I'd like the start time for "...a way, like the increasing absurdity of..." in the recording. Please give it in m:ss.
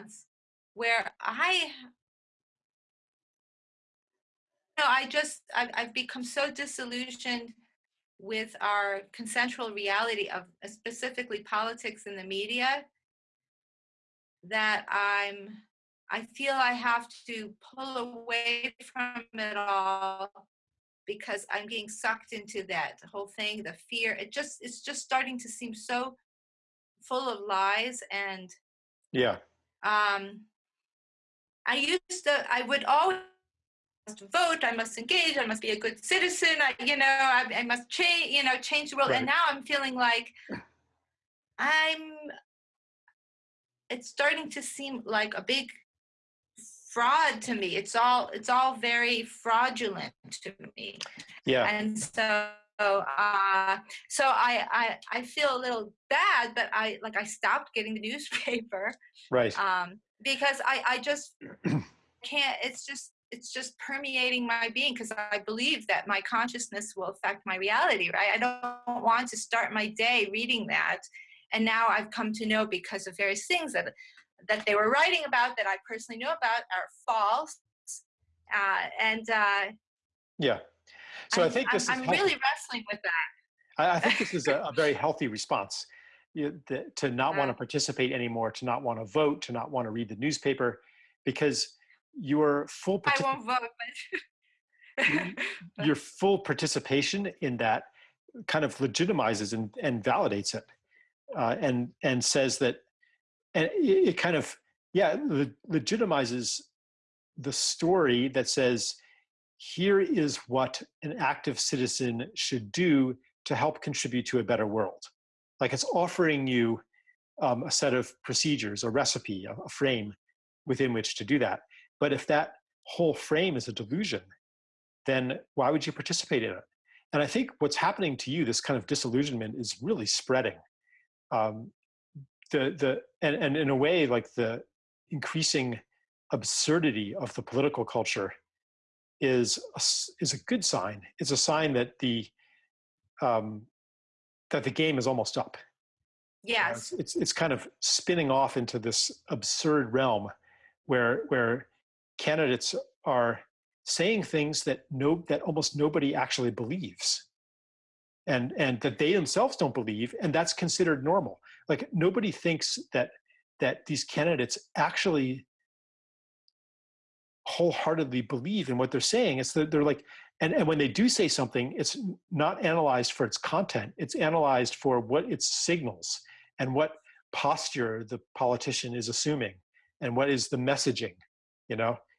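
2:13.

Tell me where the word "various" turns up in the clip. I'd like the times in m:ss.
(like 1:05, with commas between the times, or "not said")
1:13.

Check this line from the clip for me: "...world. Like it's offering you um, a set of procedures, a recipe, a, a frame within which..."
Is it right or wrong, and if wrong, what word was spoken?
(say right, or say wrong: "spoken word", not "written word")
right.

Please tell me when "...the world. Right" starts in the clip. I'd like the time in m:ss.
0:38.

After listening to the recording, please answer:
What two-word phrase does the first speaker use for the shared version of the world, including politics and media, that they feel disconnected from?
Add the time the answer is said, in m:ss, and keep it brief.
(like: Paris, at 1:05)
consensual reality, at 0:09.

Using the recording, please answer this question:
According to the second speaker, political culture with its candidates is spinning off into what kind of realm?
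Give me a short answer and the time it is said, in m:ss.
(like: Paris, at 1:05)
absurd realm, at 2:29.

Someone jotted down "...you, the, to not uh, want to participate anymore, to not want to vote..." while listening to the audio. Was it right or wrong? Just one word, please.
right.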